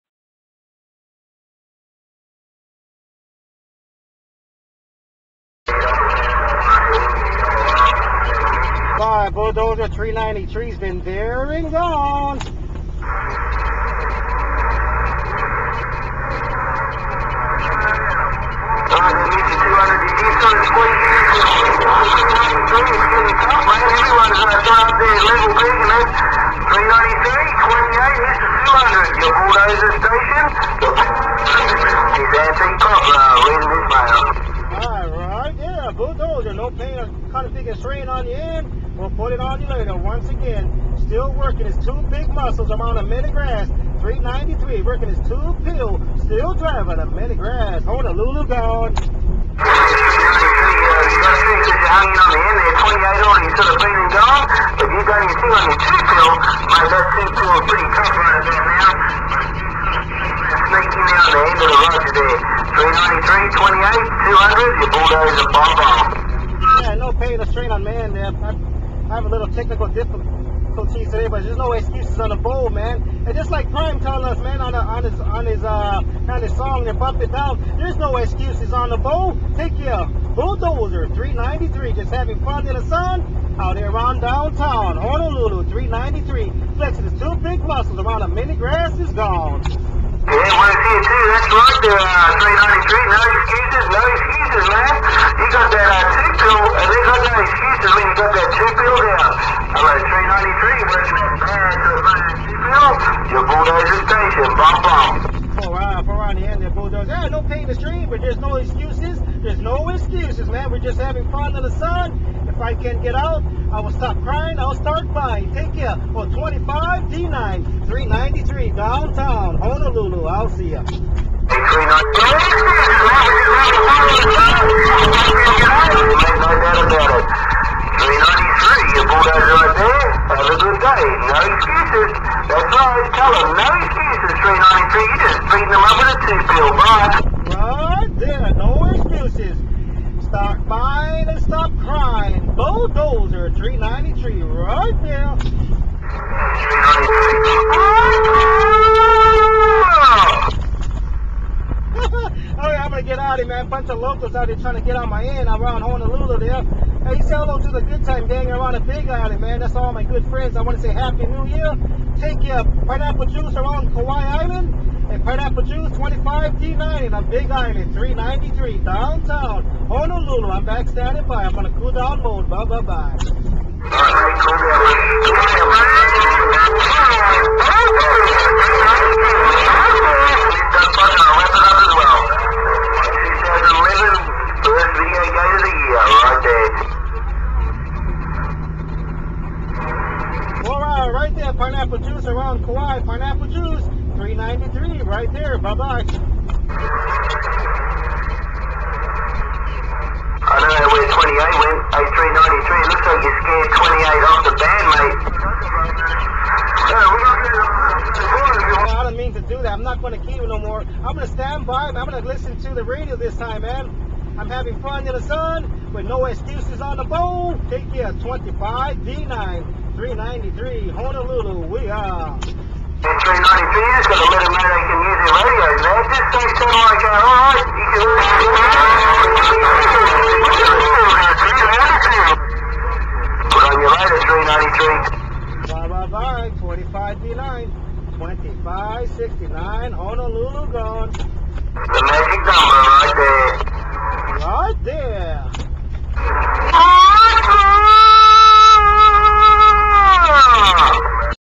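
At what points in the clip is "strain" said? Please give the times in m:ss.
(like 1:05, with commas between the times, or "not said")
0:37, 1:07.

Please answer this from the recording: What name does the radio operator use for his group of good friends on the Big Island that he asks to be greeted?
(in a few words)
Good time gang.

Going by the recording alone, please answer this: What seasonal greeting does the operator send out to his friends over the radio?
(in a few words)
Happy New Year.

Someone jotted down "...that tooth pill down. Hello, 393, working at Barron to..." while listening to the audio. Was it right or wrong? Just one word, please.
right.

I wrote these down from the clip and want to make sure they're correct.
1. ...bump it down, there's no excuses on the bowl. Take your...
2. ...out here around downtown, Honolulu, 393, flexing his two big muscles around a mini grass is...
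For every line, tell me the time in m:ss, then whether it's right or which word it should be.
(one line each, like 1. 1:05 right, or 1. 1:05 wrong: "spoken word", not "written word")
1. 1:16 right
2. 1:23 right.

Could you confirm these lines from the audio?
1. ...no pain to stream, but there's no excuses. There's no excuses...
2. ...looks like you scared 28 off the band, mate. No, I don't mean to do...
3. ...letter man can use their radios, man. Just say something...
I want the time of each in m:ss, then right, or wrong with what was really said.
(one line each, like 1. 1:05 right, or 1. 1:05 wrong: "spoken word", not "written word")
1. 1:47 right
2. 3:22 right
3. 3:43 right.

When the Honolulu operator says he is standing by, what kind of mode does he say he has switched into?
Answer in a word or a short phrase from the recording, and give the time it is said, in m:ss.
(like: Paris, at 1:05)
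Cool down mode, at 2:51.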